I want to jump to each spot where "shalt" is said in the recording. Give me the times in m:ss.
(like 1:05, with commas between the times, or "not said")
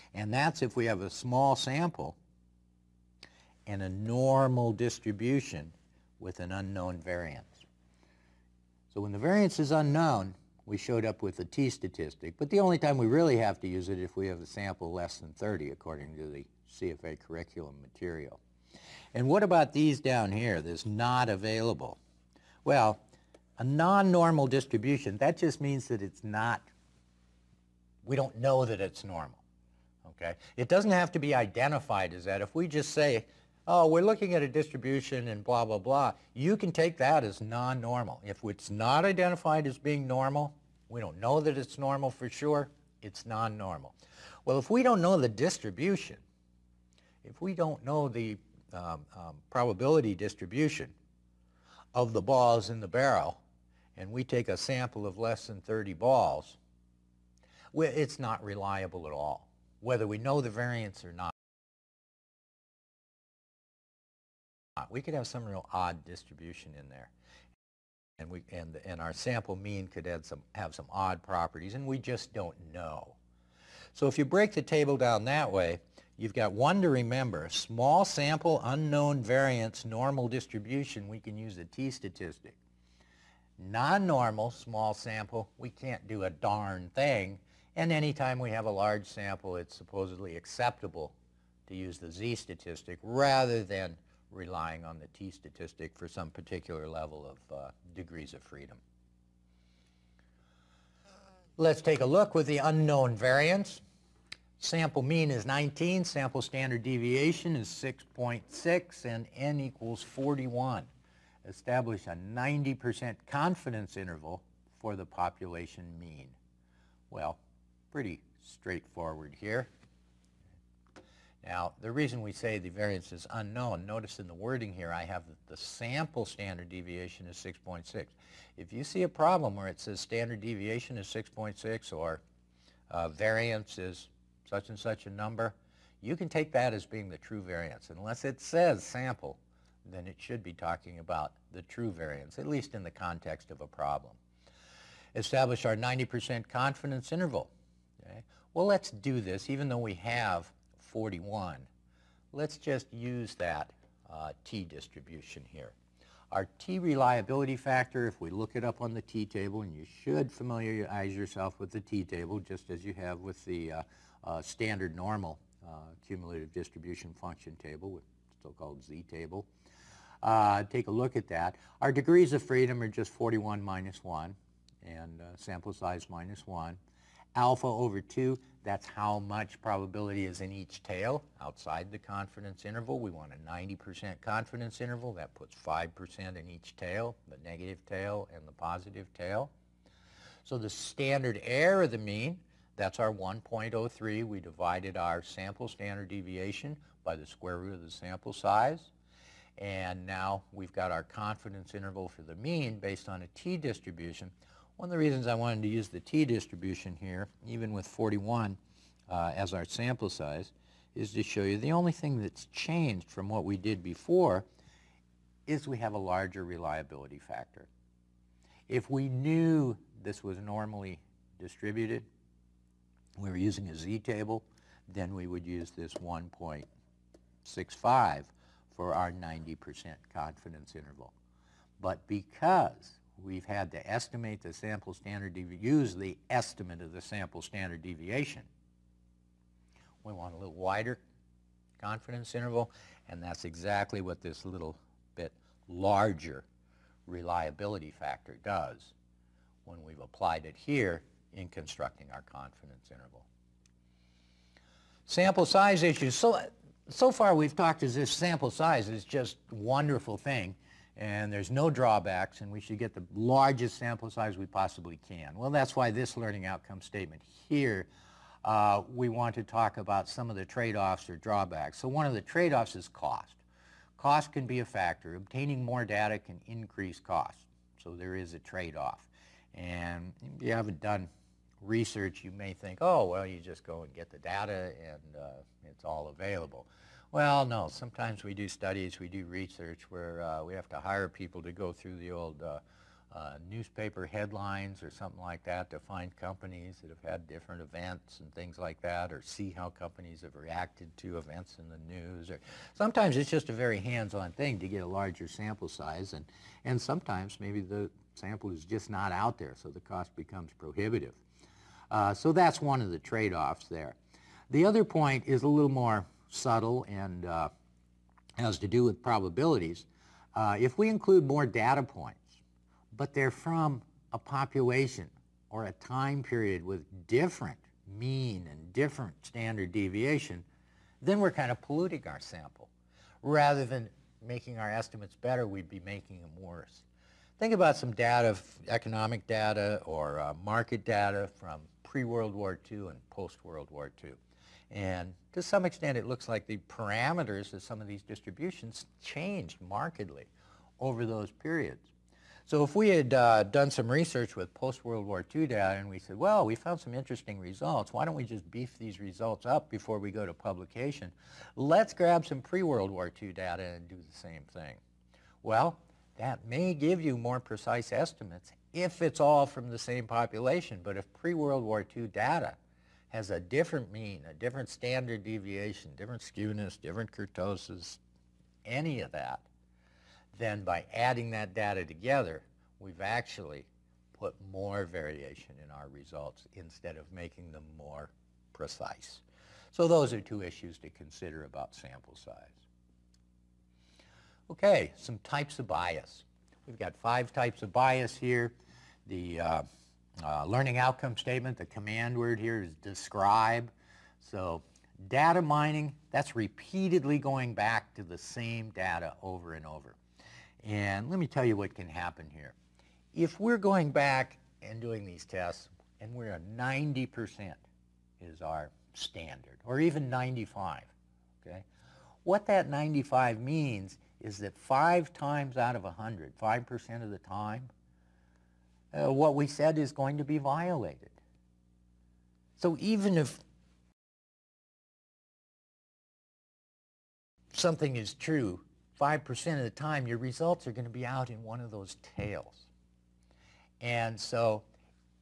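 not said.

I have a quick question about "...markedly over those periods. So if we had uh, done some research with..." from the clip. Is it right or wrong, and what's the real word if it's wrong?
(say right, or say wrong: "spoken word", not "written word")
right.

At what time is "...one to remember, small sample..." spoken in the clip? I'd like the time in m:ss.
1:16.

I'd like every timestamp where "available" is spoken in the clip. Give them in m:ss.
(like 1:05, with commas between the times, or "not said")
0:21, 4:46.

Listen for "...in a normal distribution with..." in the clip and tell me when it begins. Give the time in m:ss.
0:03.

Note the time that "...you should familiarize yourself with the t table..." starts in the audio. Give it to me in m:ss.
2:39.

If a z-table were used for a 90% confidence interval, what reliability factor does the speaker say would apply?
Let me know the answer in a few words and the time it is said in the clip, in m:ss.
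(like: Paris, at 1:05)
1.65, at 3:45.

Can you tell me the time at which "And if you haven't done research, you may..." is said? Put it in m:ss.
4:39.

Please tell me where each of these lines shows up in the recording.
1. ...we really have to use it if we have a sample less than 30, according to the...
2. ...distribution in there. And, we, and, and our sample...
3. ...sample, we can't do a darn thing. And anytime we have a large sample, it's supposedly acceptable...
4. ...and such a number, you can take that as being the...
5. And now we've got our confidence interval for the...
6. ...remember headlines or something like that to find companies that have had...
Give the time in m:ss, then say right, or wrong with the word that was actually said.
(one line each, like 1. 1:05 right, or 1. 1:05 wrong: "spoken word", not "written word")
1. 0:12 right
2. 1:06 right
3. 1:24 right
4. 2:14 right
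5. 3:19 right
6. 4:53 wrong: "newspaper", not "remember".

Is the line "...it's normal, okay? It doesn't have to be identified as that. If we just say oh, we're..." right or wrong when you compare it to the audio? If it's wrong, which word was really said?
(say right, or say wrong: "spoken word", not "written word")
right.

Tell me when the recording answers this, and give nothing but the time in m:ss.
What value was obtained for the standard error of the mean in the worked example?
3:13.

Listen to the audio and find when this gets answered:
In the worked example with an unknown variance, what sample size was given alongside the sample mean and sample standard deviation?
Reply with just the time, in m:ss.
1:49.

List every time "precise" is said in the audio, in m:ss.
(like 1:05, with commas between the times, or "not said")
6:07, 6:28.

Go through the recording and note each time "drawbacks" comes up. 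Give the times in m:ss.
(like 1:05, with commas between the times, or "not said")
4:21, 4:31.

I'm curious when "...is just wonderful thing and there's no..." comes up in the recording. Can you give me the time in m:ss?
4:18.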